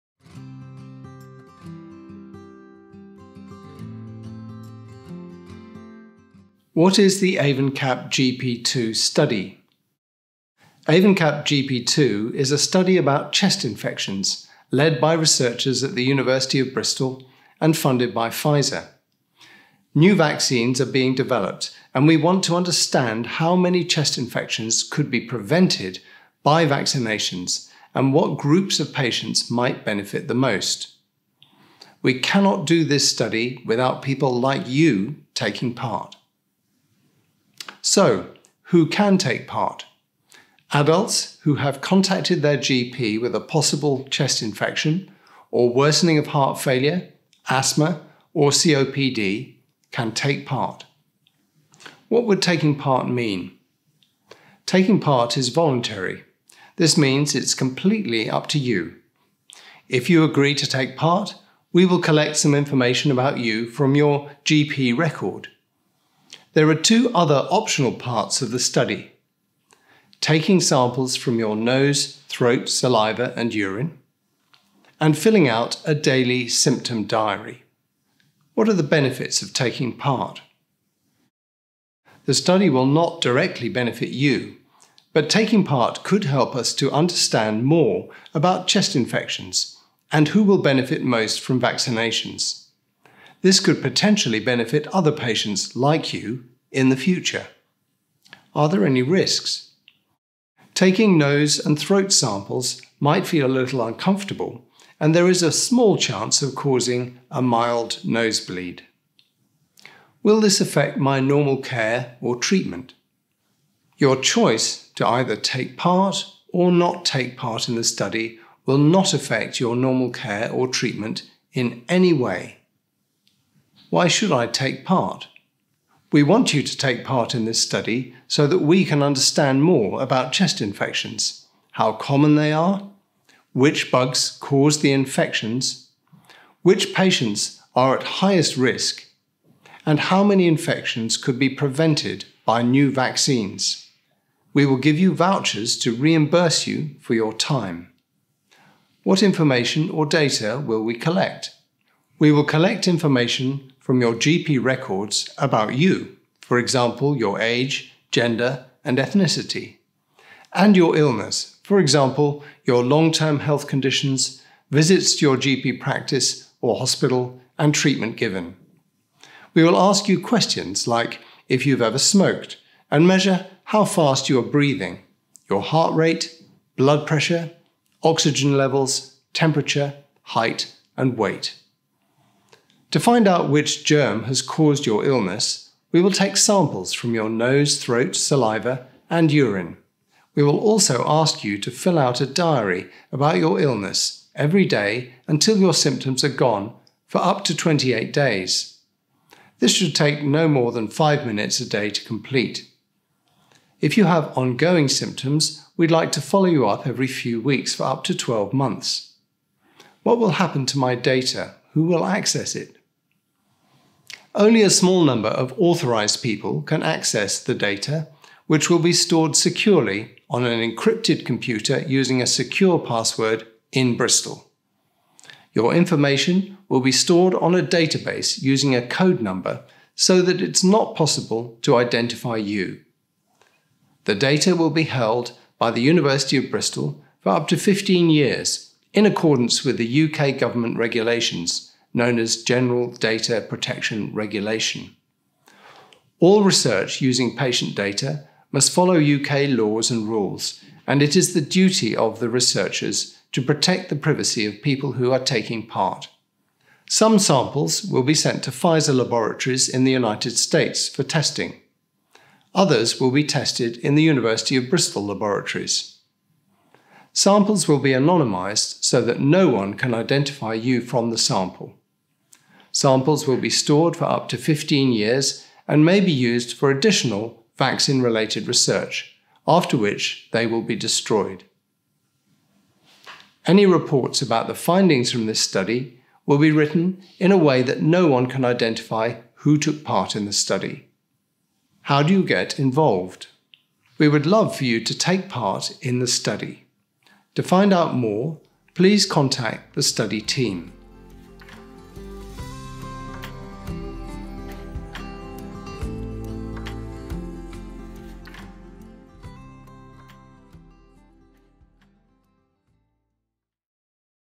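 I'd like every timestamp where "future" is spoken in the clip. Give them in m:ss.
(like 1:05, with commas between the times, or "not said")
1:36.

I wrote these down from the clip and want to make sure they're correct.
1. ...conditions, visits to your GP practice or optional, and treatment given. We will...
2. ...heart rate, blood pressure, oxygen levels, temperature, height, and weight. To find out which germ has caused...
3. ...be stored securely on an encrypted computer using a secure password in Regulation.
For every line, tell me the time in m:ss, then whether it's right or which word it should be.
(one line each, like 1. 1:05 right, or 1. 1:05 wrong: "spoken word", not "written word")
1. 2:43 wrong: "hospital", not "optional"
2. 2:55 right
3. 3:38 wrong: "Bristol", not "Regulation".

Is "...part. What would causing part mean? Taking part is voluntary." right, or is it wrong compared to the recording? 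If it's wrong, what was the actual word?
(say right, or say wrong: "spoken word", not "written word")
wrong: "taking", not "causing".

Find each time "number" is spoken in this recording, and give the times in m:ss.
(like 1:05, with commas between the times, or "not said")
3:35, 3:49.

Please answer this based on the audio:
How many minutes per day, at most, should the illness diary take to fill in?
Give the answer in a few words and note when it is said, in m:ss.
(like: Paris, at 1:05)
5, at 3:20.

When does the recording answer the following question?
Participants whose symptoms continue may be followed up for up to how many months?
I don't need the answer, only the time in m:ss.
3:28.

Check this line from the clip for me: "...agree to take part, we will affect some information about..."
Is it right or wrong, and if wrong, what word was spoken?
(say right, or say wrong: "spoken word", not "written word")
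wrong: "collect", not "affect".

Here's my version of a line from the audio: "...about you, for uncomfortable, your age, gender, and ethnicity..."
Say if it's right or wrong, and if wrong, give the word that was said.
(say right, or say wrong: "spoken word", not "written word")
wrong: "example", not "uncomfortable".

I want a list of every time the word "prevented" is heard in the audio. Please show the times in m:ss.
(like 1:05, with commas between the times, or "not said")
0:25, 2:21.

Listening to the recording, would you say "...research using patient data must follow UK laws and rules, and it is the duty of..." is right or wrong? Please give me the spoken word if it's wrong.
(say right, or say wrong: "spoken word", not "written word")
right.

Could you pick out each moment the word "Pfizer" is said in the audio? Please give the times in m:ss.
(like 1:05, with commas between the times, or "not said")
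0:18, 4:18.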